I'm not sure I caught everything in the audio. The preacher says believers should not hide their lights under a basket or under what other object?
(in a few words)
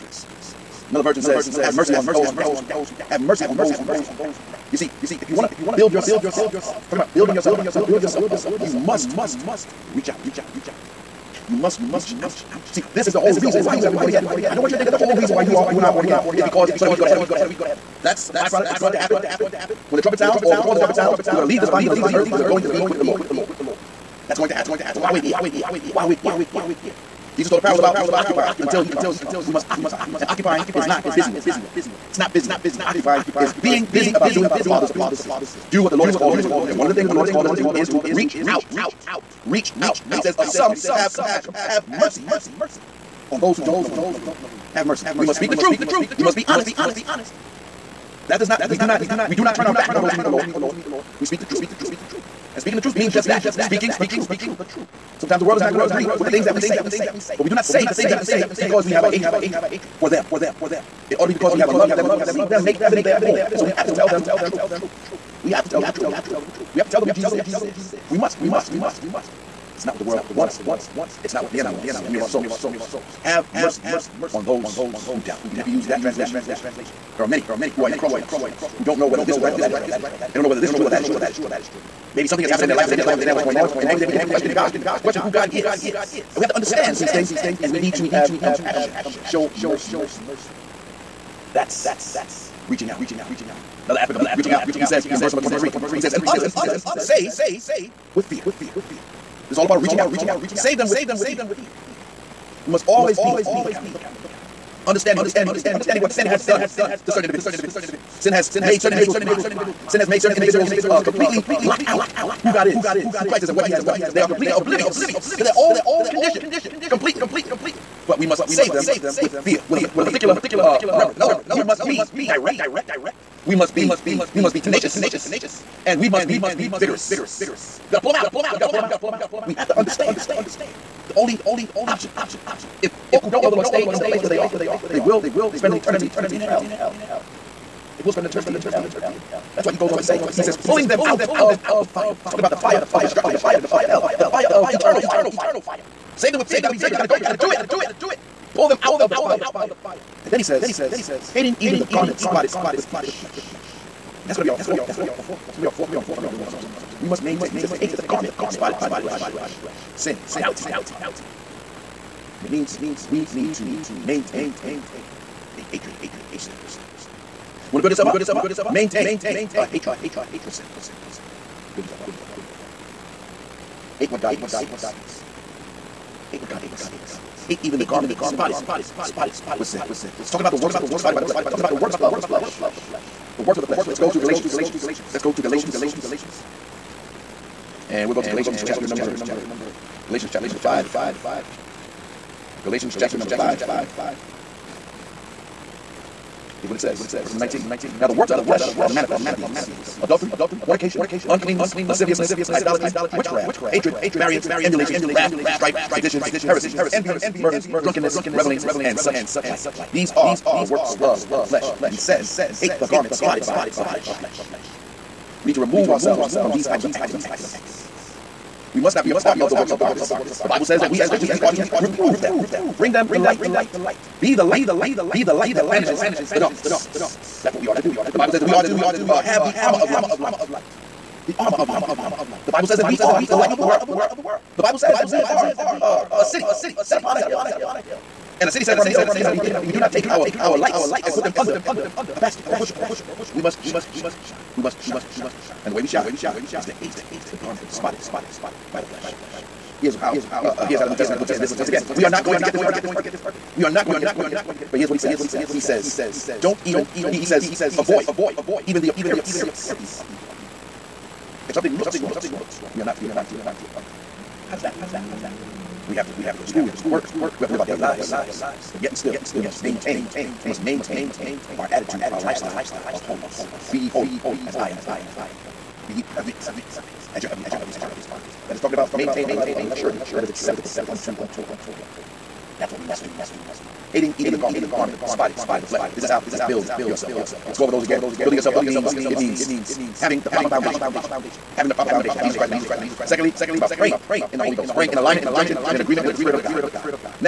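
A bushel.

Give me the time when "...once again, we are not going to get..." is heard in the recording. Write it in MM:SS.
04:11.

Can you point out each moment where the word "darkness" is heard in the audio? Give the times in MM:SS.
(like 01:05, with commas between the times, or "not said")
03:39, 03:46.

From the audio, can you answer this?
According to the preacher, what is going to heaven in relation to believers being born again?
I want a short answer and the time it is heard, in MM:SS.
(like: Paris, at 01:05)
A byproduct, at 00:18.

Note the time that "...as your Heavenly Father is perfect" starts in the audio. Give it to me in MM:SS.
04:37.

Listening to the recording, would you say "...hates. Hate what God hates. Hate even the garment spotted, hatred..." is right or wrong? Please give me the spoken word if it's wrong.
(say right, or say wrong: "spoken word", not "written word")
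wrong: "spotted", not "hatred".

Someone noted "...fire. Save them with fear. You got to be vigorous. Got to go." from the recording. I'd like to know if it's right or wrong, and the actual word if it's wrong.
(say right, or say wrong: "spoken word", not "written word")
right.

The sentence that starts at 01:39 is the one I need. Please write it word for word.
This is all about of reaching out.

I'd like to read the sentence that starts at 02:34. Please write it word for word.
And that's going to be our fourth point.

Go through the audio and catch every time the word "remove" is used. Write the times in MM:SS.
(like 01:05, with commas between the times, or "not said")
03:35.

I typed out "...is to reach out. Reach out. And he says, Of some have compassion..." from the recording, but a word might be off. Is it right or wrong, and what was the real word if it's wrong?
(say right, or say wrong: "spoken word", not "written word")
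right.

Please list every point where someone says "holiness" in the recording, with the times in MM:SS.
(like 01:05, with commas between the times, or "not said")
04:33.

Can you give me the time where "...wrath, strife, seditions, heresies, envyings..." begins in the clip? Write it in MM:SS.
03:25.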